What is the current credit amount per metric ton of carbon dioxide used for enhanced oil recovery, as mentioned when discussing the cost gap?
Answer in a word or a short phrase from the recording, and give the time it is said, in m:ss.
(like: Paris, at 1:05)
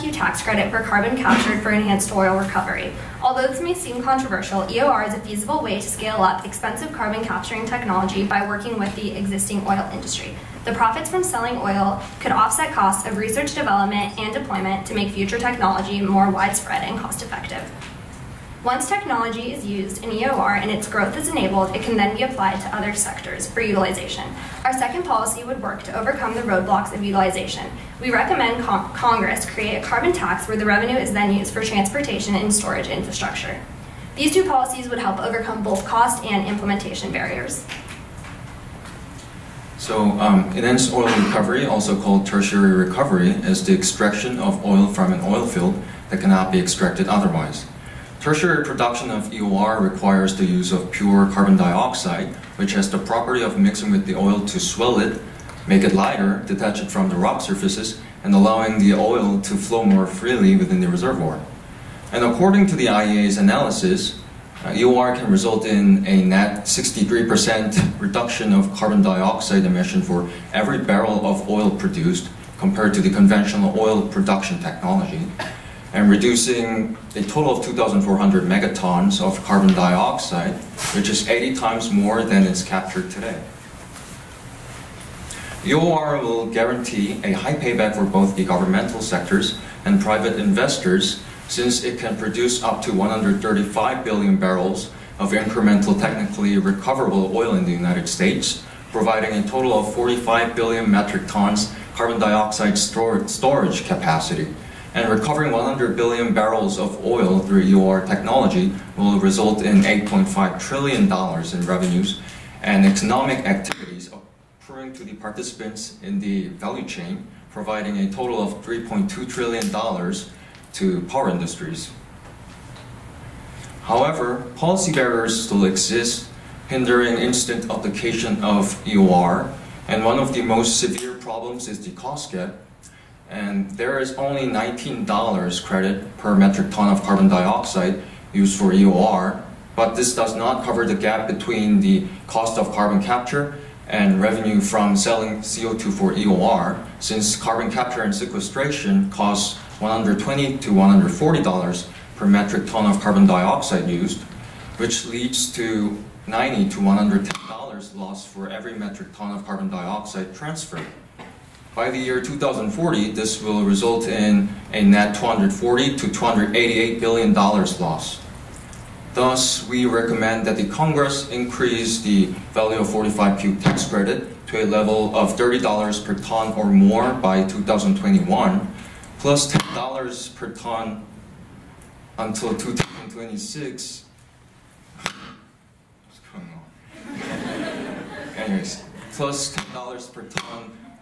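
$19, at 2:14.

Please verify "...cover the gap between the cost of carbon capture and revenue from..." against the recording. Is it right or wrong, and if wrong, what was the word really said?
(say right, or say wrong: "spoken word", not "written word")
right.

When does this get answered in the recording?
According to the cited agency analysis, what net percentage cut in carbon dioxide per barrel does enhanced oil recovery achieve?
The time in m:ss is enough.
1:06.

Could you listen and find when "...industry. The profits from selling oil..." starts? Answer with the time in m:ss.
0:09.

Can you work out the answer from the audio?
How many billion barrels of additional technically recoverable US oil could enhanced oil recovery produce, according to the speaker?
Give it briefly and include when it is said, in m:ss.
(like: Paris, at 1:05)
135 billion, at 1:32.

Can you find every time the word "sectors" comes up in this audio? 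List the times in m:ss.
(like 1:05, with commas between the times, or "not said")
0:22, 1:29.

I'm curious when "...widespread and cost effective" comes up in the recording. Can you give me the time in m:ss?
0:16.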